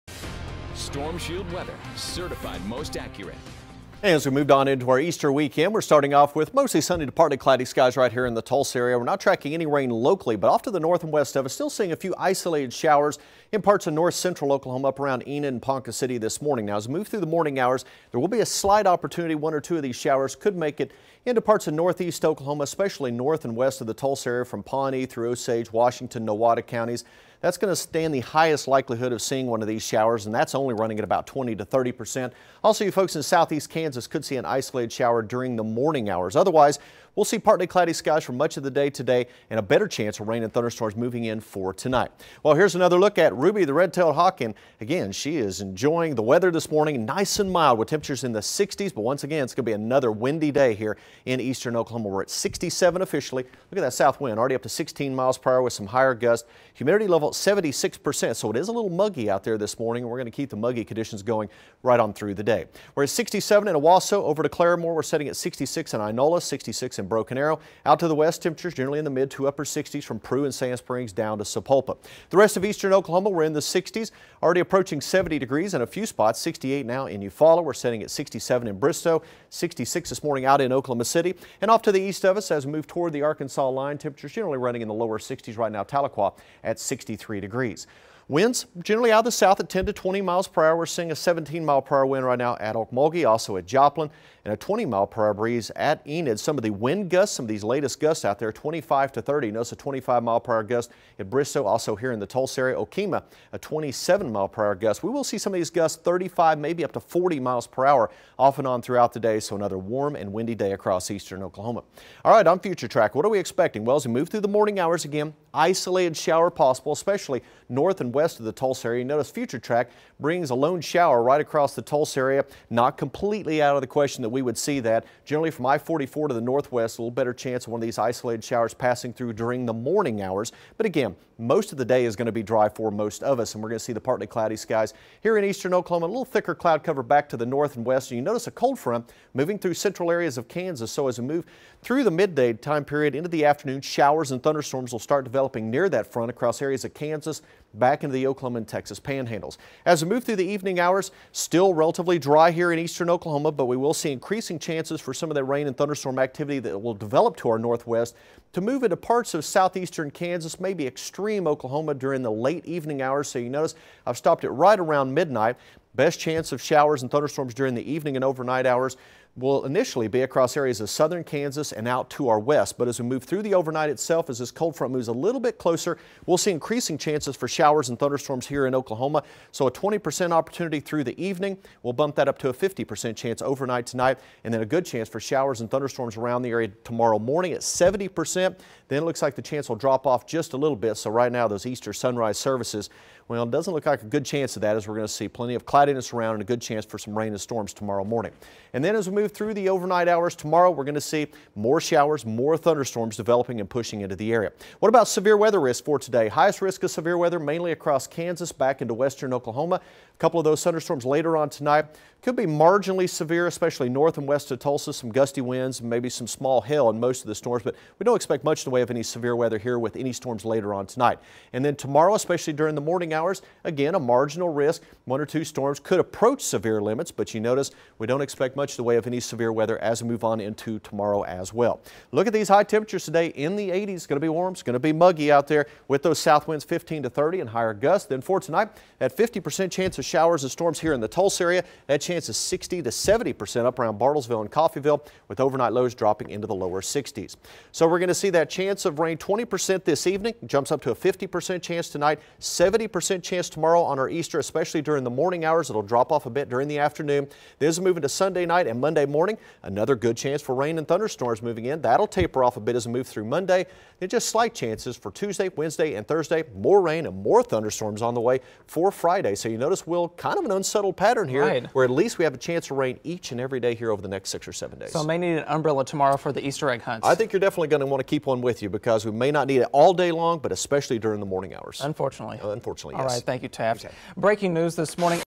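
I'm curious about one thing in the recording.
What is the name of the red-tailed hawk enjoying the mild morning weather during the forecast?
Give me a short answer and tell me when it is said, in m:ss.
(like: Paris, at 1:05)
Ruby, at 0:43.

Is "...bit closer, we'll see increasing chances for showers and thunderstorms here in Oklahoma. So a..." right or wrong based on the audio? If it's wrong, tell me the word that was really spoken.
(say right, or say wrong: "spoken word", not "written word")
right.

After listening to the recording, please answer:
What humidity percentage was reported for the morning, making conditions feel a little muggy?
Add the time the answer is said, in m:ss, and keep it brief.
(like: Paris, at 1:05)
76%, at 0:57.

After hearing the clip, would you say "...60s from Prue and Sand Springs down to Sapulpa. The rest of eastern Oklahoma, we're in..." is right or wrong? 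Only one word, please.
right.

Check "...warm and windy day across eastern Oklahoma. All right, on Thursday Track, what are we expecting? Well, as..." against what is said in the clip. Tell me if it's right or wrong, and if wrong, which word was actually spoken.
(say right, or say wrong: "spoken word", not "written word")
wrong: "Future", not "Thursday".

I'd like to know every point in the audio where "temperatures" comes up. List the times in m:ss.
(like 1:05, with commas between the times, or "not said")
0:47, 1:08, 1:23, 3:52.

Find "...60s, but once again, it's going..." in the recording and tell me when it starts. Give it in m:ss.
0:48.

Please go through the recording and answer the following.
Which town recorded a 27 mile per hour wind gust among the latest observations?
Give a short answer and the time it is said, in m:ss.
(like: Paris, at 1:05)
Okemah, at 1:42.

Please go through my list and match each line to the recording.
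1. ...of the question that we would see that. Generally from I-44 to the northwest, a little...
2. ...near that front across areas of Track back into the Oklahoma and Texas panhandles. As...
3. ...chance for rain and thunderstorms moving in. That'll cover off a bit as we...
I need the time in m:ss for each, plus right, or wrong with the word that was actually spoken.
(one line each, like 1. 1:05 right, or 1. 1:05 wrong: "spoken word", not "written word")
1. 2:03 right
2. 2:25 wrong: "Kansas", not "Track"
3. 4:20 wrong: "taper", not "cover".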